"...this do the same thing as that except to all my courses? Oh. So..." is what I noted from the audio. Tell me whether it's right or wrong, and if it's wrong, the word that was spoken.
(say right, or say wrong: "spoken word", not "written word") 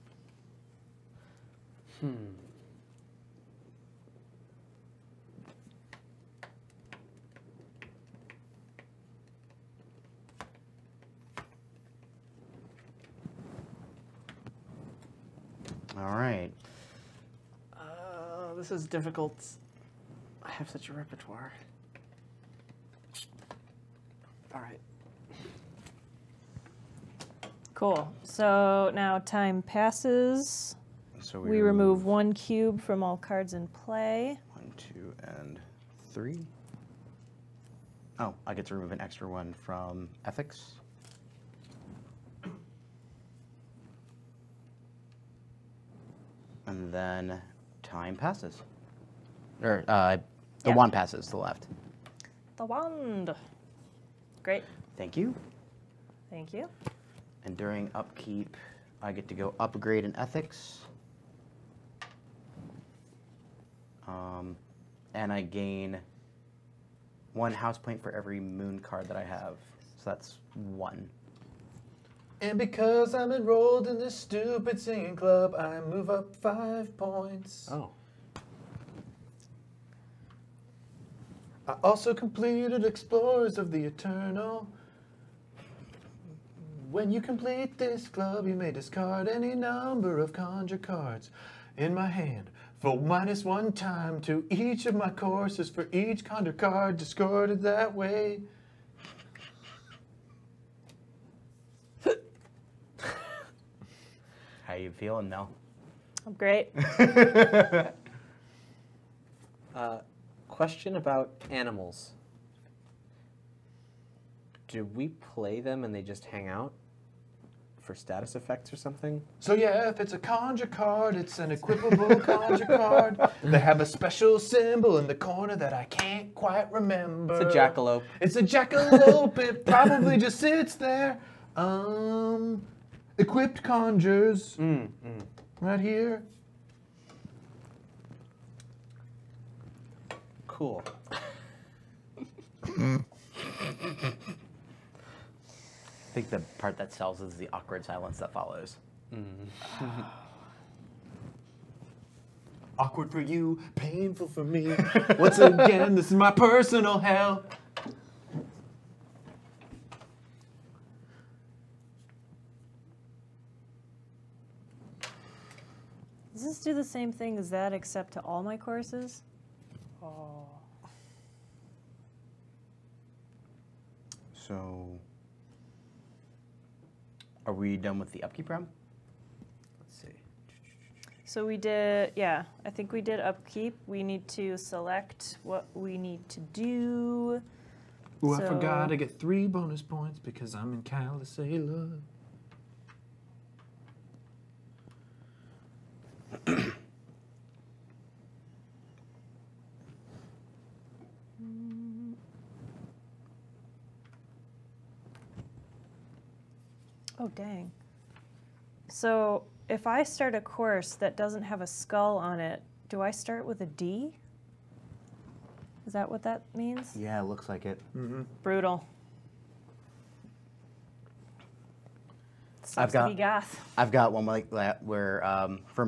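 right.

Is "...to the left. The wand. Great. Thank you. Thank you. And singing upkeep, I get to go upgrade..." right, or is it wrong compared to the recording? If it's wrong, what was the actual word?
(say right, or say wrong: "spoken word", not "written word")
wrong: "during", not "singing".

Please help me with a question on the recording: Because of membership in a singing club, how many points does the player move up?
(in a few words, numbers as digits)
5.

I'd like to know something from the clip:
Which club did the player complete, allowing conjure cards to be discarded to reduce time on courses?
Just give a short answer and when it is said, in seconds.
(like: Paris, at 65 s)
Explorers of the Eternal, at 82 s.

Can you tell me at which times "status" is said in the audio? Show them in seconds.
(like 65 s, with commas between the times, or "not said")
117 s.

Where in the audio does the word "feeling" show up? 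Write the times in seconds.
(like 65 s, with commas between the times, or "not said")
104 s.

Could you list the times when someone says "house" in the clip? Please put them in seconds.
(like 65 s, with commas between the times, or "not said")
67 s.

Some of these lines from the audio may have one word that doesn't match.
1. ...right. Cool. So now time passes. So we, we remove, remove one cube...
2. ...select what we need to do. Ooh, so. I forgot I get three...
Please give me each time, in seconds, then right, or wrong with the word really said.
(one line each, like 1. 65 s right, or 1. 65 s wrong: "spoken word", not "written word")
1. 24 s right
2. 184 s right.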